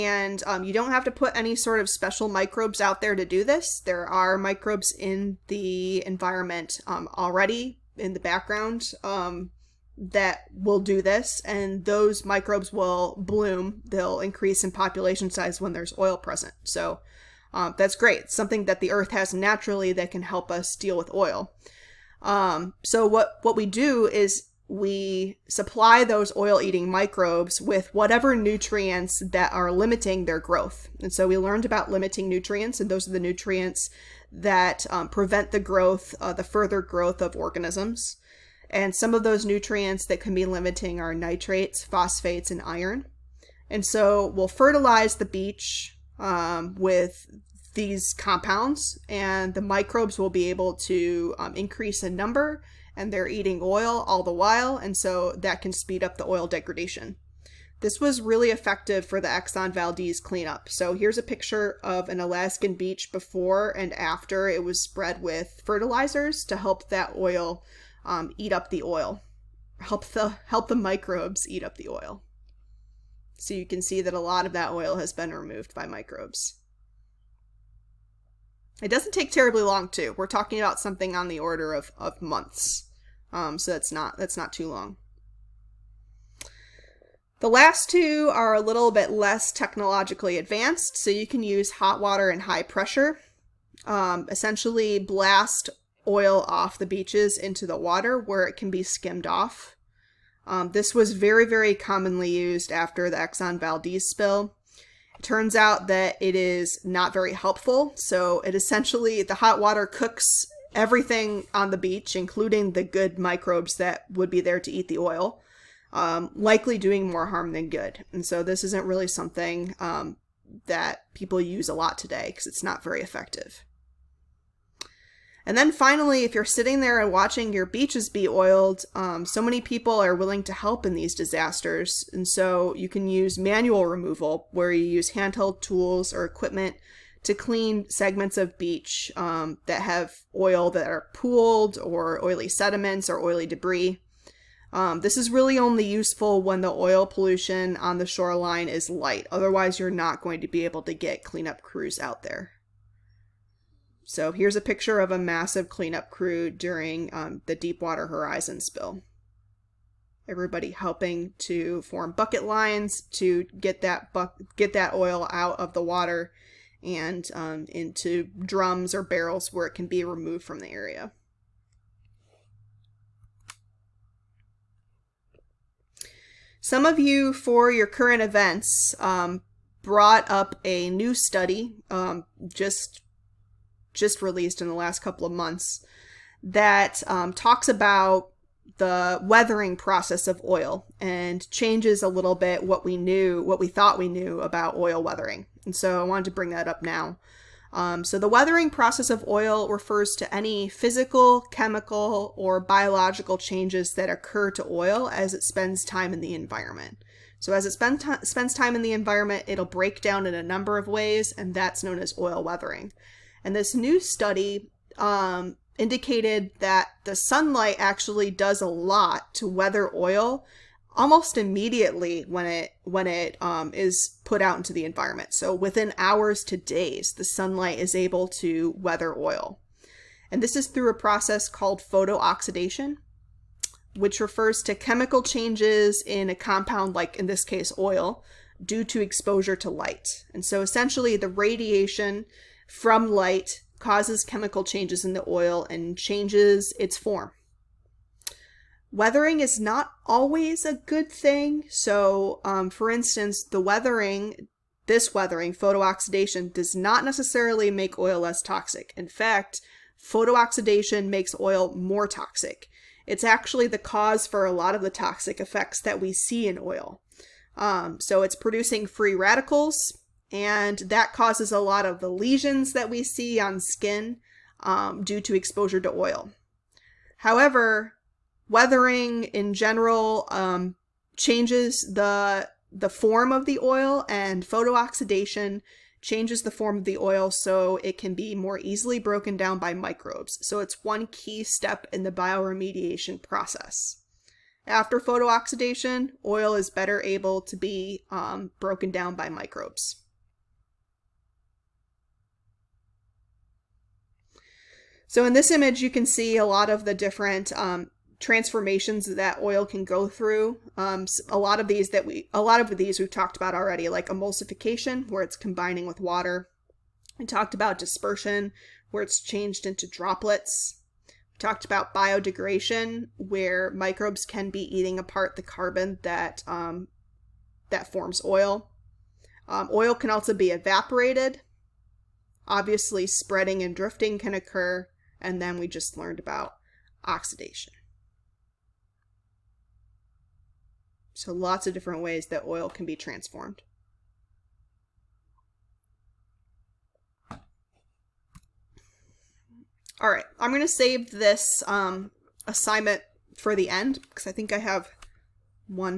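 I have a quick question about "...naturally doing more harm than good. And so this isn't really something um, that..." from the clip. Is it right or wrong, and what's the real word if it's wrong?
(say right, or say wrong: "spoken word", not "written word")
wrong: "likely", not "naturally".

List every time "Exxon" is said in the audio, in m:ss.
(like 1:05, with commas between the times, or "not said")
0:59, 1:43.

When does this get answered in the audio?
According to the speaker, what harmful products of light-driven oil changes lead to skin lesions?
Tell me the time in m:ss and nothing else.
4:28.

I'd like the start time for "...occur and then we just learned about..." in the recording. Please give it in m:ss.
5:34.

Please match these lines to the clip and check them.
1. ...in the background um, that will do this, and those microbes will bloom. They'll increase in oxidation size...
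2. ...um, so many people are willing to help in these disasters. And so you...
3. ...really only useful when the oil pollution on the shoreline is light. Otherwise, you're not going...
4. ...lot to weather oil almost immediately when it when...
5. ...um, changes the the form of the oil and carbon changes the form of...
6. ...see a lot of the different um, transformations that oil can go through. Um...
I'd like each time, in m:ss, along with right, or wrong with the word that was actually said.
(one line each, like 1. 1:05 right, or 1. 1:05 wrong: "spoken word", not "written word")
1. 0:07 wrong: "population", not "oxidation"
2. 2:08 right
3. 2:25 right
4. 3:38 right
5. 4:40 wrong: "photooxidation", not "carbon"
6. 5:06 right.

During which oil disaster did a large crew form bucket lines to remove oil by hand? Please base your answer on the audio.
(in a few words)
Deepwater Horizon.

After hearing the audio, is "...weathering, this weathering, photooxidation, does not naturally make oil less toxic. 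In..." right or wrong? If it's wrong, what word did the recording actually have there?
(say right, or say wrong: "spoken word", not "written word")
wrong: "necessarily", not "naturally".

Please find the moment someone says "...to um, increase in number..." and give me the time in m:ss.
0:50.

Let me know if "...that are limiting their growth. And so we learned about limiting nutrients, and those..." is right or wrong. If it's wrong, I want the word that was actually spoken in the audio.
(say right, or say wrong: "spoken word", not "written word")
right.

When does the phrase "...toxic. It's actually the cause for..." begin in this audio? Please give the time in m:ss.
4:22.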